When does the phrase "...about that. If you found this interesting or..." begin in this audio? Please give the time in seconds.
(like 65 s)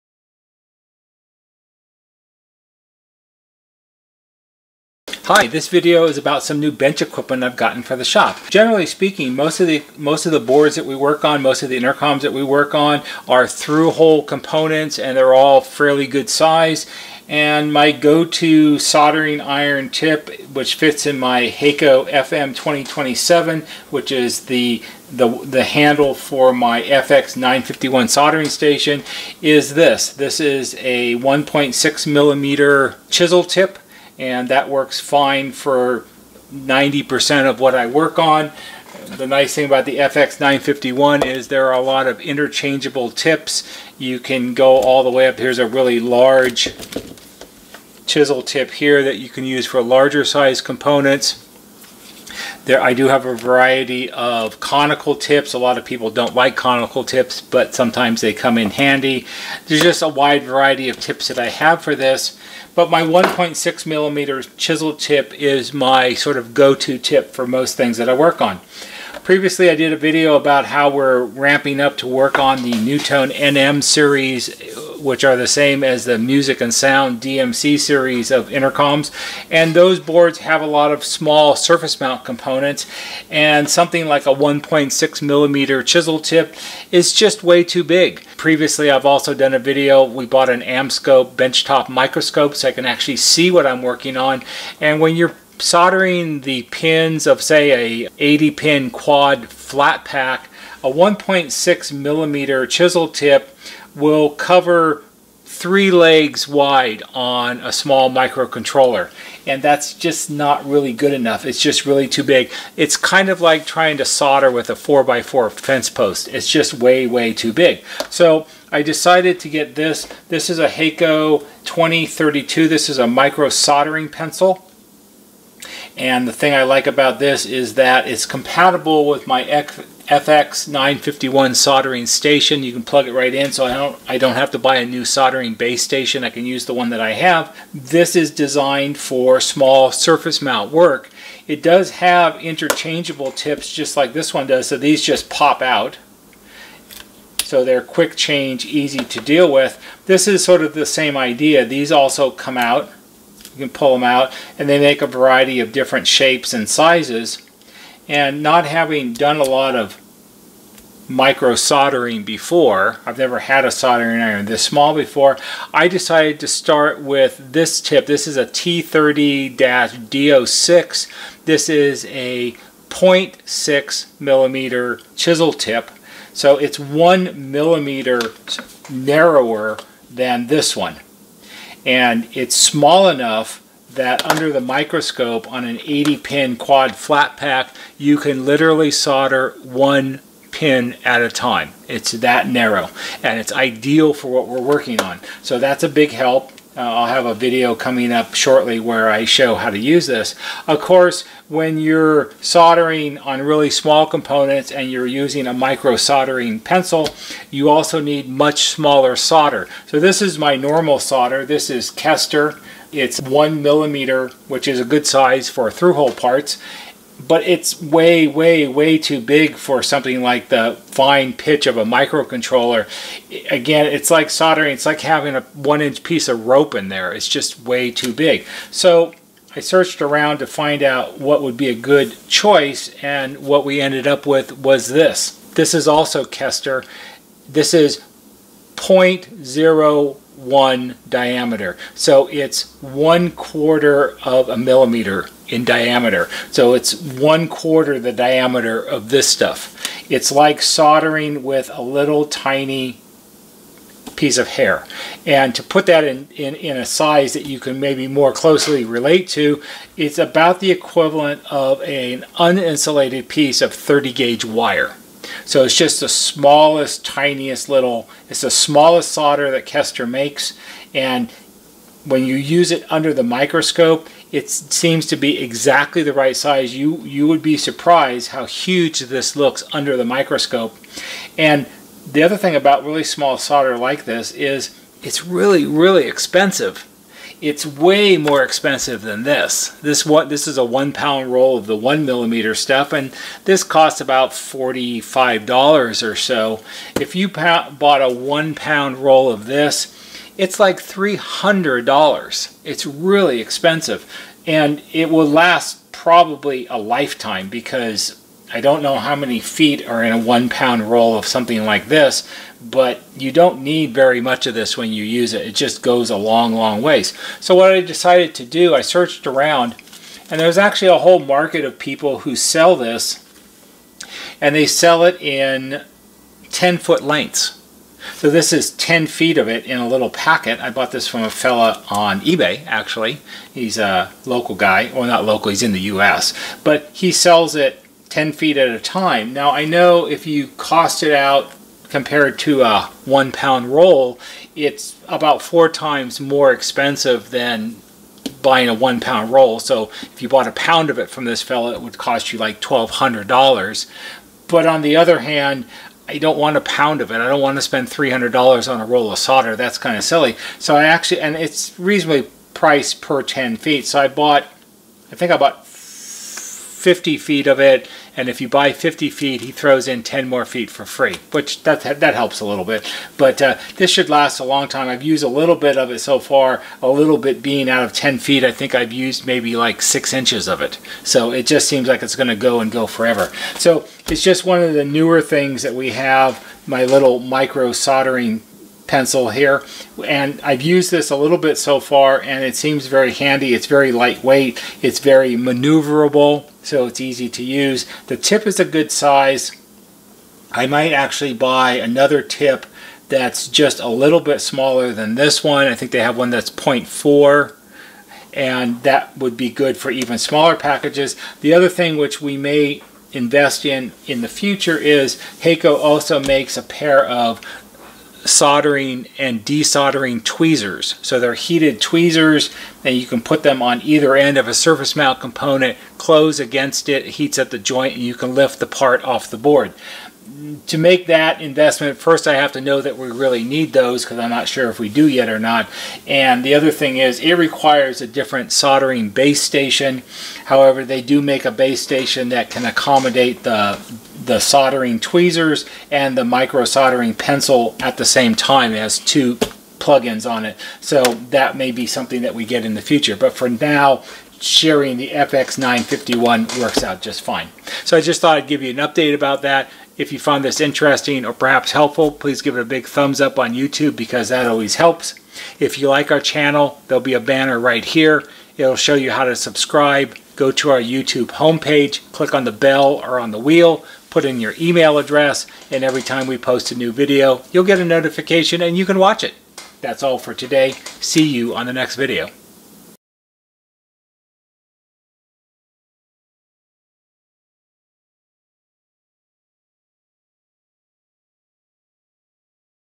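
459 s.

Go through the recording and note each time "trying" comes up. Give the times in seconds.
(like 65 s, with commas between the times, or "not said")
113 s.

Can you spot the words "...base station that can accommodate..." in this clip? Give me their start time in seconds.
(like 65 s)
441 s.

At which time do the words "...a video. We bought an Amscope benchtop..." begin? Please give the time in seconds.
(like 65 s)
89 s.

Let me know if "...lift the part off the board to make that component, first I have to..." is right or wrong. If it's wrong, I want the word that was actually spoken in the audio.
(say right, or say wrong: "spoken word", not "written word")
wrong: "investment", not "component".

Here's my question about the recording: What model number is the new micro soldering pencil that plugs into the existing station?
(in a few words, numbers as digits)
Hakko 2032.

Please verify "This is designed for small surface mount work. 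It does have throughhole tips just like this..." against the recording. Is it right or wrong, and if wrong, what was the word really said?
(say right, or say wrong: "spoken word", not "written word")
wrong: "interchangeable", not "throughhole".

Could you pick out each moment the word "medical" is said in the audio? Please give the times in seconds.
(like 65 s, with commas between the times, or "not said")
not said.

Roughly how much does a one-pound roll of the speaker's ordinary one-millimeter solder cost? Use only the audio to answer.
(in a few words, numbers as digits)
$45.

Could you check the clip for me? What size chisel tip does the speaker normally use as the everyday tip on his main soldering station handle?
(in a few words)
1.6 millimeter.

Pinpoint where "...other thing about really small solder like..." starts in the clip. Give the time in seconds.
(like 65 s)
282 s.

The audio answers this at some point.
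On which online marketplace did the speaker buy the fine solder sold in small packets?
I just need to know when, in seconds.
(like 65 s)
332 s.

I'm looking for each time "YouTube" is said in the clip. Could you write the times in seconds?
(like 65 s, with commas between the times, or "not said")
463 s, 470 s.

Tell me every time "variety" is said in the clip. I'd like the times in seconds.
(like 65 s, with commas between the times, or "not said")
53 s, 60 s, 155 s.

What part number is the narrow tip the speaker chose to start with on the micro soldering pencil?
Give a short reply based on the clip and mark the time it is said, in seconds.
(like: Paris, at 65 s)
T30-DO6, at 168 s.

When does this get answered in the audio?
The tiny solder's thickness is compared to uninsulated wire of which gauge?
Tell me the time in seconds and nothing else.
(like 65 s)
263 s.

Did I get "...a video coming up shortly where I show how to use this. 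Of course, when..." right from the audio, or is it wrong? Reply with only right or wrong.
right.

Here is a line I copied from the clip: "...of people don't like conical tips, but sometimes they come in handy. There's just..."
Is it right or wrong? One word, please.
right.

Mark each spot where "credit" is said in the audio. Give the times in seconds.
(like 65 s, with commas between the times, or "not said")
not said.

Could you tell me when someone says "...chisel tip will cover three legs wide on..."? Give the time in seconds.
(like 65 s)
102 s.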